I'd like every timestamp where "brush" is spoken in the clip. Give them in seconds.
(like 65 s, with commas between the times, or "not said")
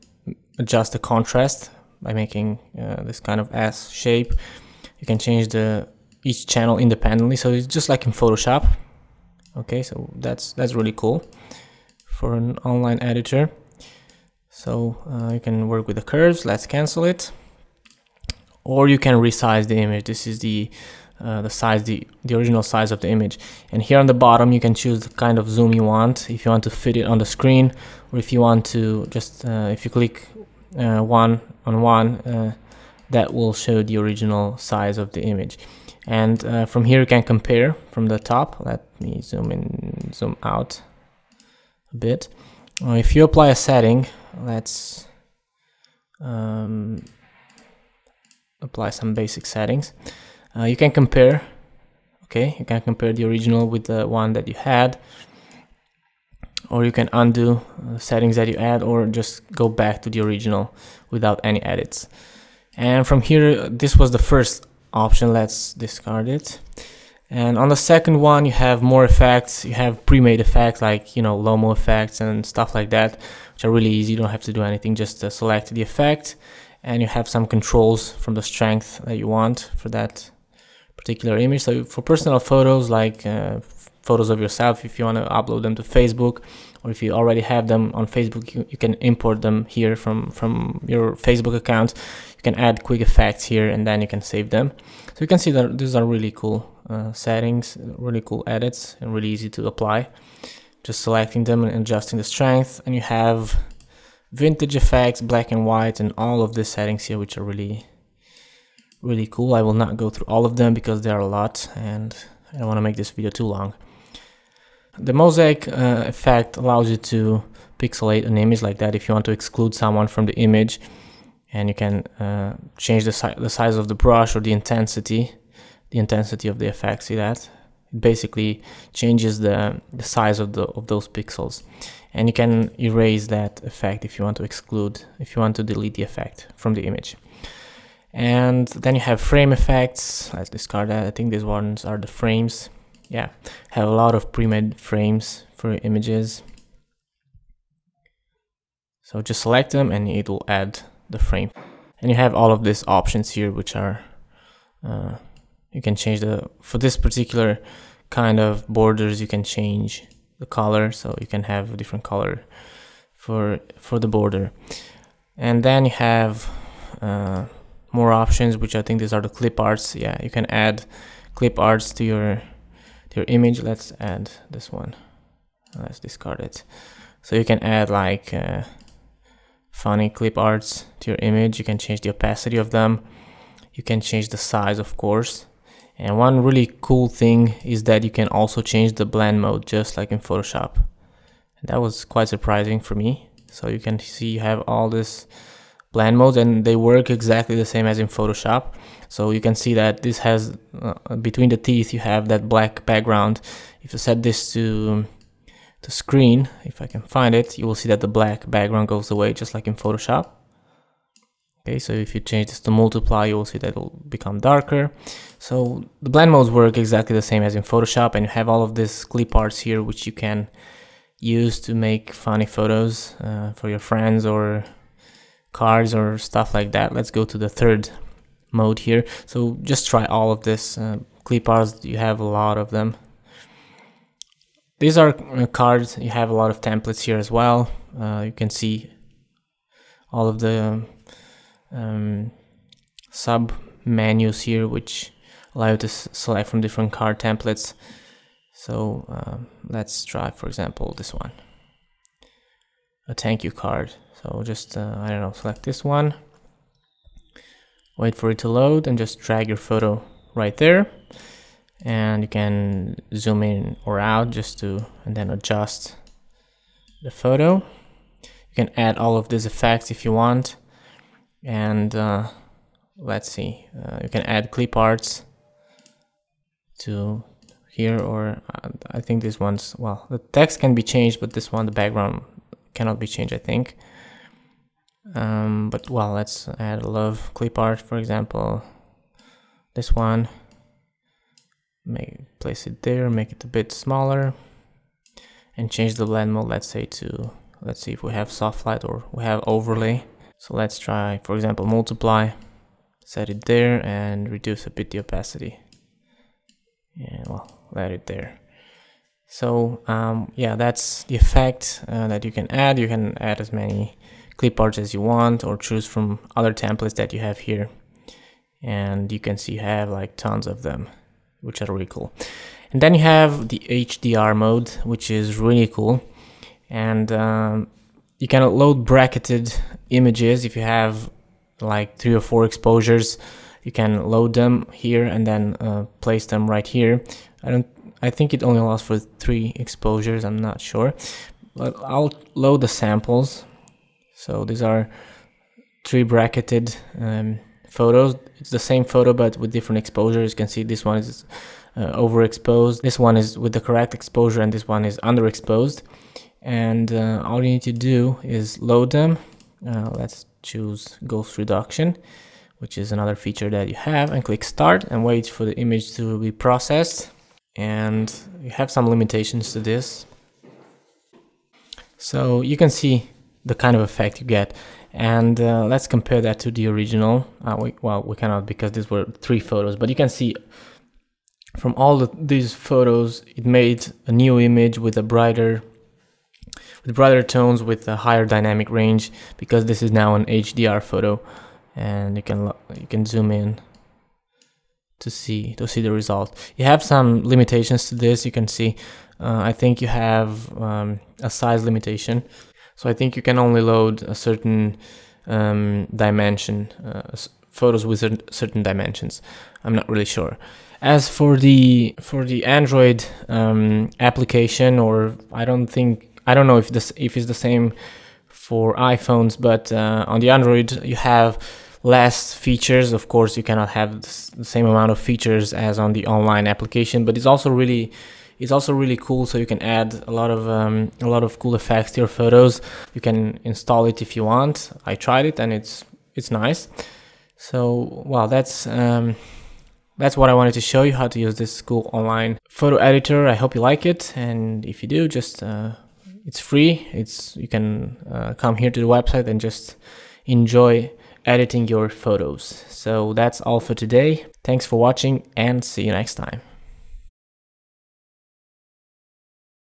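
123 s.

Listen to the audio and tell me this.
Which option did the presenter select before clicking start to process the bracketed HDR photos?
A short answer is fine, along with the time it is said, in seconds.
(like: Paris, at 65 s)
Ghost reduction, at 361 s.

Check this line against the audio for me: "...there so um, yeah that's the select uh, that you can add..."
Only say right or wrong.
wrong.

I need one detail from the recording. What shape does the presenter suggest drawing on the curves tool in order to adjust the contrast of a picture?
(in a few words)
S shape.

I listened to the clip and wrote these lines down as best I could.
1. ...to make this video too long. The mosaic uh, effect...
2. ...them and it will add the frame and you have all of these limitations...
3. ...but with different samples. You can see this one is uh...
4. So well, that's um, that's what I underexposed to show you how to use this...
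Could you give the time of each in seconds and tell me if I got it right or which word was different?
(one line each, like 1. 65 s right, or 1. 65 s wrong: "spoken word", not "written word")
1. 112 s right
2. 149 s wrong: "options", not "limitations"
3. 349 s wrong: "exposures", not "samples"
4. 437 s wrong: "wanted", not "underexposed".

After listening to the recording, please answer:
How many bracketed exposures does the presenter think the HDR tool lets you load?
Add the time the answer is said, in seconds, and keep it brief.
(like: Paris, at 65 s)
3, at 338 s.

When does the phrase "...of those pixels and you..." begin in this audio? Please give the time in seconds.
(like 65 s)
130 s.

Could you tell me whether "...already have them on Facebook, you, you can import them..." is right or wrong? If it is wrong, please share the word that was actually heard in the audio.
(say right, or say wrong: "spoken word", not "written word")
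right.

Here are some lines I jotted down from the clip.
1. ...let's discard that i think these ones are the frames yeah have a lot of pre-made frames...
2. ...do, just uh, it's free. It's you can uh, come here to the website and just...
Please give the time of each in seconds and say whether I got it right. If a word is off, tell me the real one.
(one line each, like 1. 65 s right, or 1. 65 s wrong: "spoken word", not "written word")
1. 140 s right
2. 444 s right.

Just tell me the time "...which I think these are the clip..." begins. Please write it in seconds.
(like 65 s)
168 s.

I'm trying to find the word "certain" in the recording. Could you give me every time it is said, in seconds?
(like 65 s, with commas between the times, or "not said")
404 s, 408 s.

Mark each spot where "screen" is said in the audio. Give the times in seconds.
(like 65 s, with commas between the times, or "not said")
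27 s, 205 s.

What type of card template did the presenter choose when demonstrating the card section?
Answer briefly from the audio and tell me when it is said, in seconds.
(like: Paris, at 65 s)
Thank you card, at 253 s.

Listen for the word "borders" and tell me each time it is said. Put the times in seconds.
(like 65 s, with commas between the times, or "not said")
158 s, 164 s.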